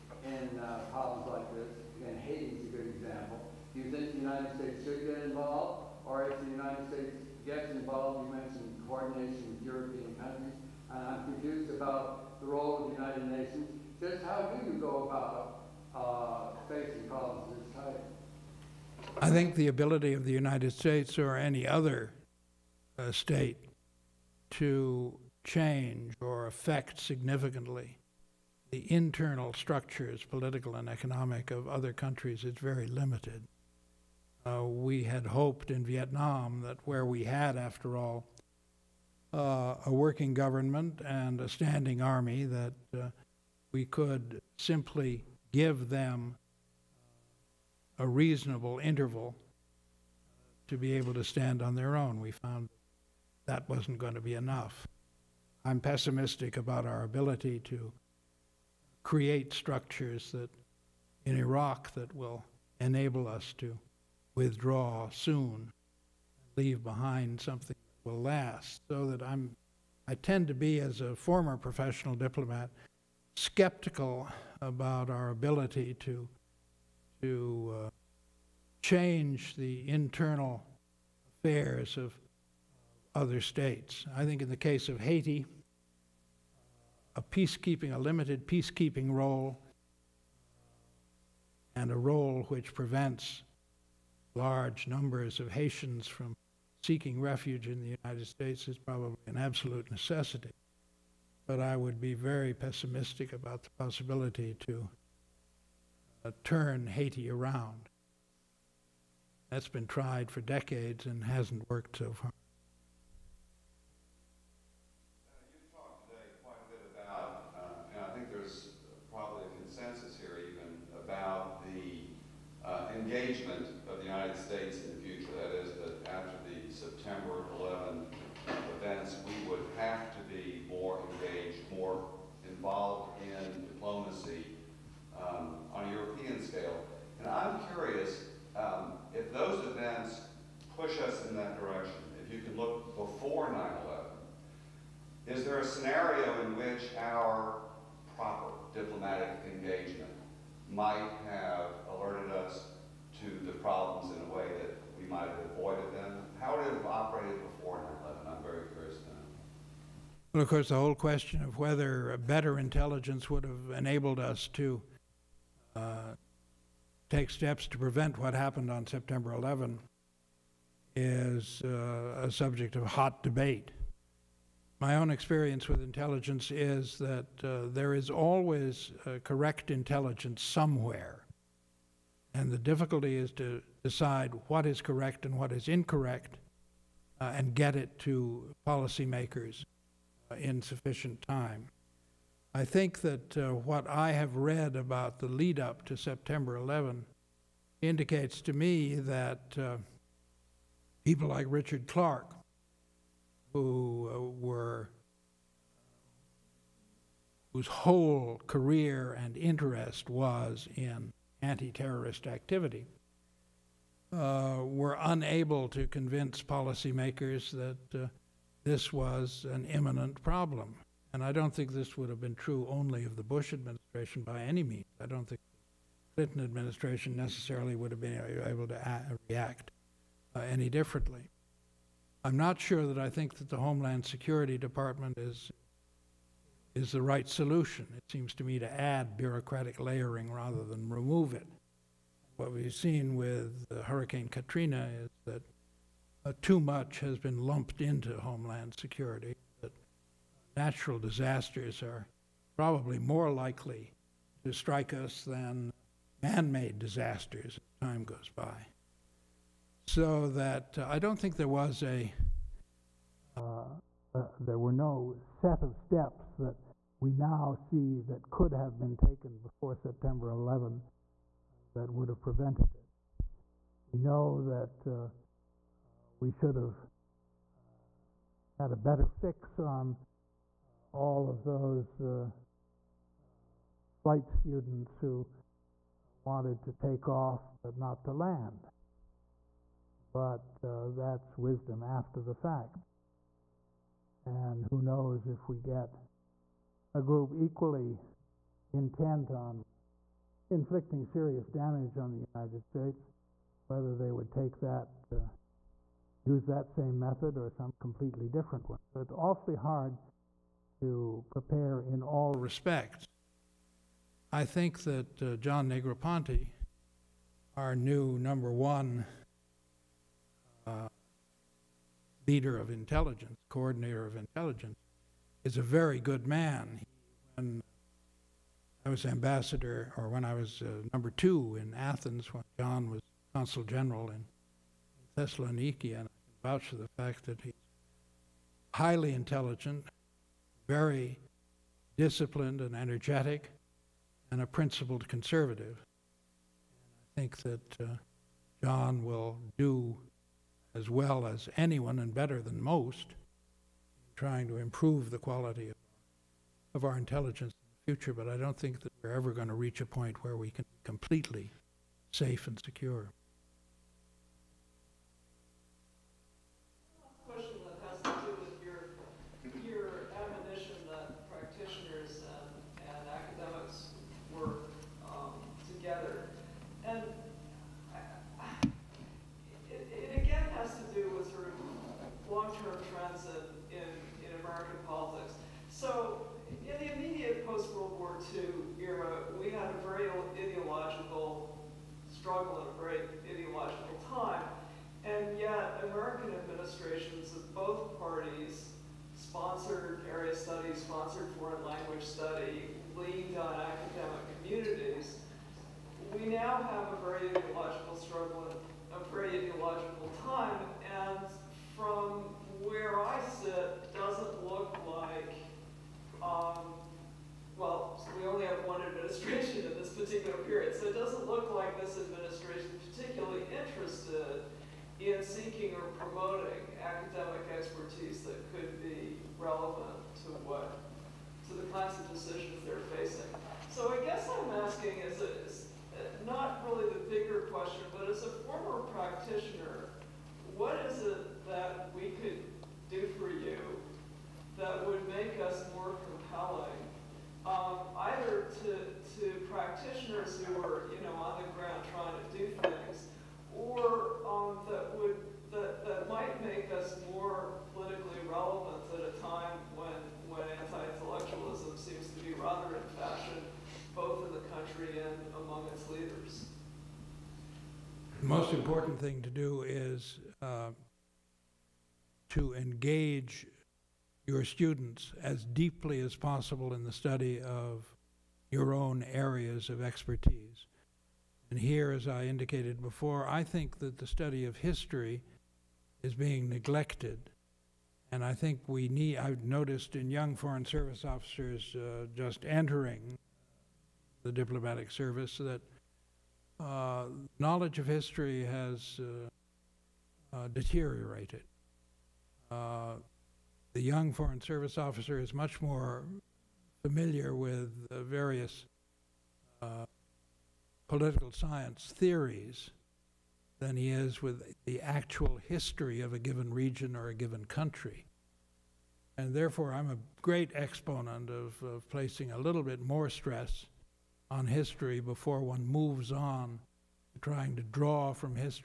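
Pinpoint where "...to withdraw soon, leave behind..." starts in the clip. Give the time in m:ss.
1:03.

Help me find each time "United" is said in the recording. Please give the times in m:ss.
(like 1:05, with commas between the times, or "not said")
0:13, 0:20, 1:38, 5:02.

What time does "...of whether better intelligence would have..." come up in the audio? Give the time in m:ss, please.
2:41.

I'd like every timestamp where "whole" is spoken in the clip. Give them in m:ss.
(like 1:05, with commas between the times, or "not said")
2:40, 3:27.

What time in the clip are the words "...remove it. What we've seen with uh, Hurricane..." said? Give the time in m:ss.
4:00.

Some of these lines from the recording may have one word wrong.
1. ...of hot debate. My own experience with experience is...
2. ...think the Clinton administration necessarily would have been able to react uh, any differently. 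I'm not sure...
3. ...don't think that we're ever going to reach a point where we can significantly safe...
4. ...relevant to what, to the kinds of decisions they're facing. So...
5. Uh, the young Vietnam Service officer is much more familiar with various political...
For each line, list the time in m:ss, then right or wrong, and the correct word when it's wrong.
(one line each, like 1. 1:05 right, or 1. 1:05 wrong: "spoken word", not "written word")
1. 2:52 wrong: "intelligence", not "experience"
2. 3:45 right
3. 5:58 wrong: "completely", not "significantly"
4. 7:09 right
5. 8:22 wrong: "Foreign", not "Vietnam".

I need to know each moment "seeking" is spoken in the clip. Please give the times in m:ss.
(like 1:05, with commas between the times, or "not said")
1:36, 7:05.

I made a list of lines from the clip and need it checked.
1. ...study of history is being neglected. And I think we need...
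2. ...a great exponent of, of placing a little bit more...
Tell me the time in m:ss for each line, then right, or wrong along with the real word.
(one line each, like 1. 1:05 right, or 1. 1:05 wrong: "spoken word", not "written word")
1. 8:04 right
2. 8:39 right.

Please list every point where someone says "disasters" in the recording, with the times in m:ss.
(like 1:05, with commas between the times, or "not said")
4:10, 4:16.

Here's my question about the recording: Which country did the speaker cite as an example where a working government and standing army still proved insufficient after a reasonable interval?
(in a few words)
Vietnam.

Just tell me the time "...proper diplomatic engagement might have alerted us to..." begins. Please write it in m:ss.
2:28.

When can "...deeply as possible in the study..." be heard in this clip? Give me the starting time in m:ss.
7:55.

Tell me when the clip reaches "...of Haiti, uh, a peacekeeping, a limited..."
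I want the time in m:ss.
1:24.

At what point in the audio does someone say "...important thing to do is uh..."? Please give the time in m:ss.
7:48.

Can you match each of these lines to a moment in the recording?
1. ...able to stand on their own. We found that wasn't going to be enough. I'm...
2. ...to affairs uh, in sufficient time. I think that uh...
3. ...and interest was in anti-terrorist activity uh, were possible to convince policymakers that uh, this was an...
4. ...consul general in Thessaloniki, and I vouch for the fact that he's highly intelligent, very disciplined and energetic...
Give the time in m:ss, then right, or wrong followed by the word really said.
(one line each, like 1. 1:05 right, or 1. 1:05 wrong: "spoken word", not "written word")
1. 0:50 right
2. 3:07 wrong: "policymakers", not "affairs"
3. 3:29 wrong: "unable", not "possible"
4. 5:33 right.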